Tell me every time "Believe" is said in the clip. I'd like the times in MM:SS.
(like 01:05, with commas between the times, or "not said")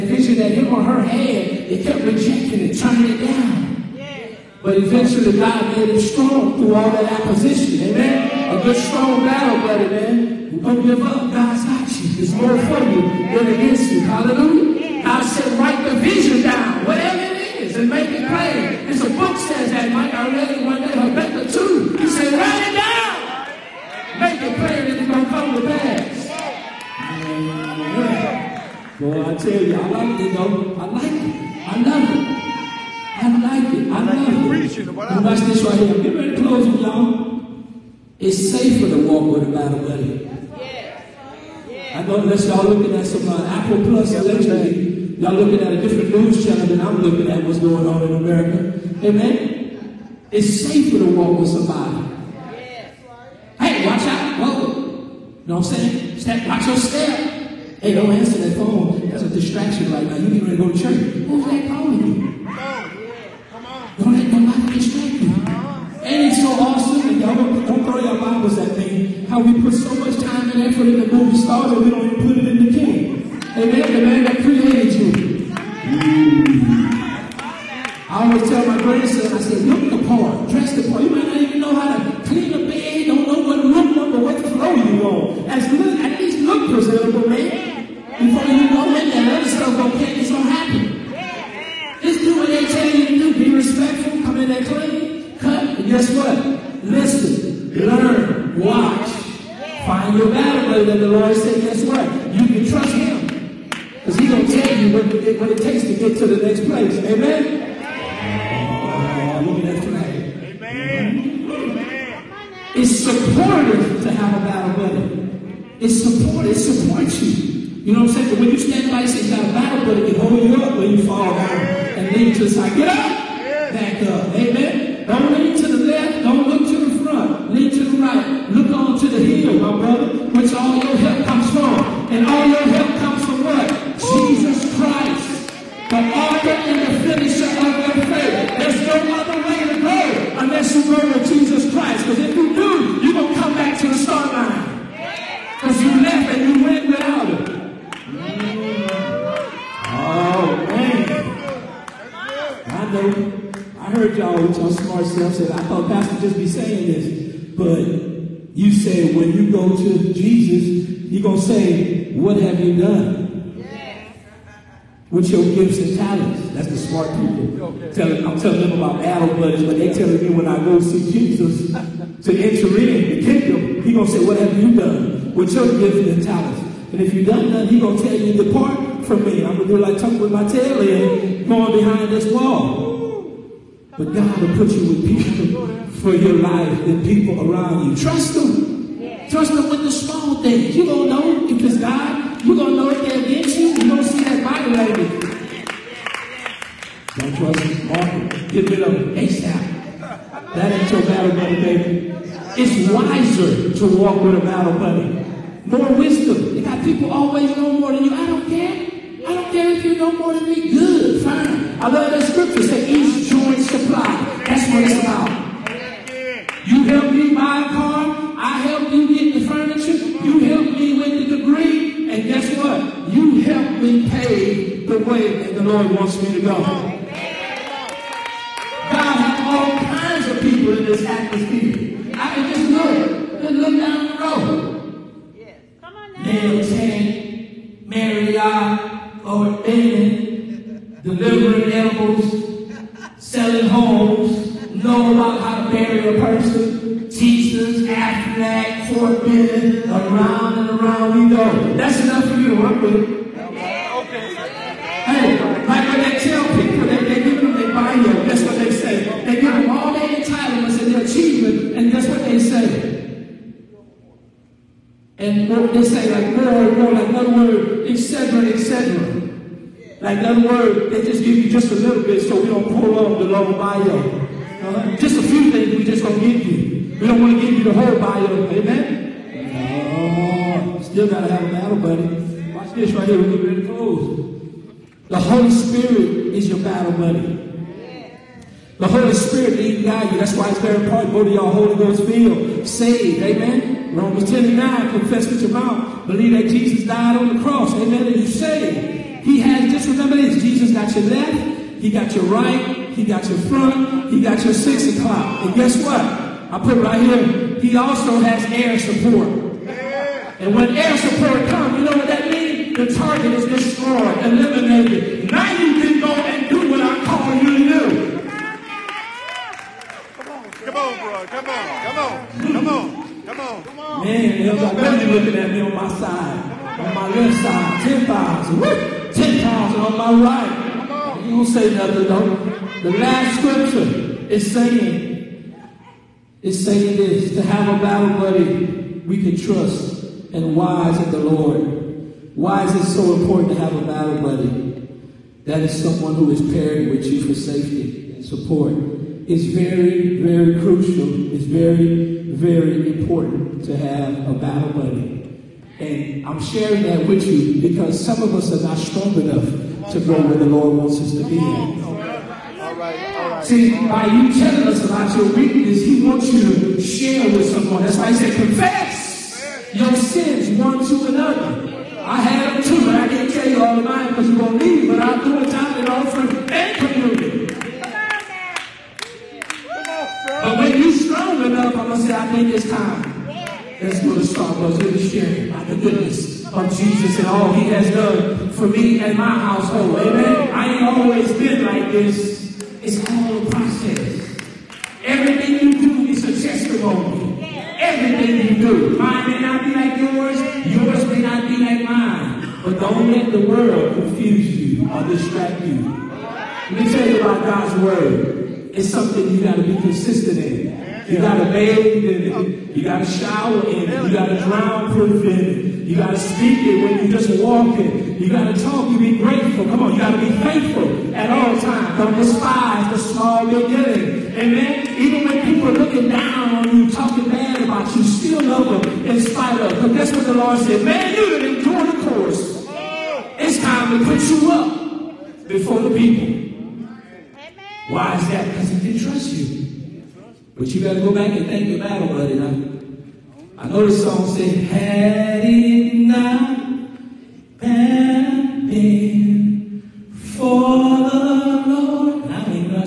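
04:56.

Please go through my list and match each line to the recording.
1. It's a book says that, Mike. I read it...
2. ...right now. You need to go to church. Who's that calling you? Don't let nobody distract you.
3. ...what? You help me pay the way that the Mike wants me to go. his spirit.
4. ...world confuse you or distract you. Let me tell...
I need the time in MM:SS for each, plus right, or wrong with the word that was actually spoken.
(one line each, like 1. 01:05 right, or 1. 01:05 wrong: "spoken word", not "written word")
1. 00:18 right
2. 00:59 right
3. 03:42 wrong: "Lord", not "Mike"
4. 06:43 right.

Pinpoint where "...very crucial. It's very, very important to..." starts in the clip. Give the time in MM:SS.
05:50.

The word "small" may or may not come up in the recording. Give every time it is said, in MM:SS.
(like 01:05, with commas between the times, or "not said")
03:09, 07:02.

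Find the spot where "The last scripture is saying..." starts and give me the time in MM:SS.
05:32.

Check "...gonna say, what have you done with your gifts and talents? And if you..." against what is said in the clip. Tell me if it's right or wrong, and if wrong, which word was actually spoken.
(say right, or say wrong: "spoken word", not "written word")
right.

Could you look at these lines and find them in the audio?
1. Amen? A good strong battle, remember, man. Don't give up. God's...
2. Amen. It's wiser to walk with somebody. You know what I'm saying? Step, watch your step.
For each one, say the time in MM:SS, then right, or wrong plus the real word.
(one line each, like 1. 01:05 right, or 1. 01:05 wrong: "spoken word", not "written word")
1. 00:07 wrong: "brother", not "remember"
2. 00:49 wrong: "safer", not "wiser".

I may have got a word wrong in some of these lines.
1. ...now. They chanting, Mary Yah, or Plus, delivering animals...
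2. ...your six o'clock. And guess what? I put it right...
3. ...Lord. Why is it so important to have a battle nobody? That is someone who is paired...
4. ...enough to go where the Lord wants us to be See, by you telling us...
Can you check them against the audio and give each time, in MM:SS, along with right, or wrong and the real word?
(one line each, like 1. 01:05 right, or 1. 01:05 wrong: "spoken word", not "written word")
1. 03:56 wrong: "David", not "Plus"
2. 05:04 right
3. 05:41 wrong: "buddy", not "nobody"
4. 05:59 right.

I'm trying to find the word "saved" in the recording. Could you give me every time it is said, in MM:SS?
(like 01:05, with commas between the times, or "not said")
04:52, 04:58.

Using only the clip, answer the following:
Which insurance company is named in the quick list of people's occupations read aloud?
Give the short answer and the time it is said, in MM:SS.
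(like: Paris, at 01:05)
Aflac, at 04:07.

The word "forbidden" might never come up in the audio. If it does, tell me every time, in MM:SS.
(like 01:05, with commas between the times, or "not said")
04:08.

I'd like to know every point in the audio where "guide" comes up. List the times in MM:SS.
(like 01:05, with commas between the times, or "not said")
04:49.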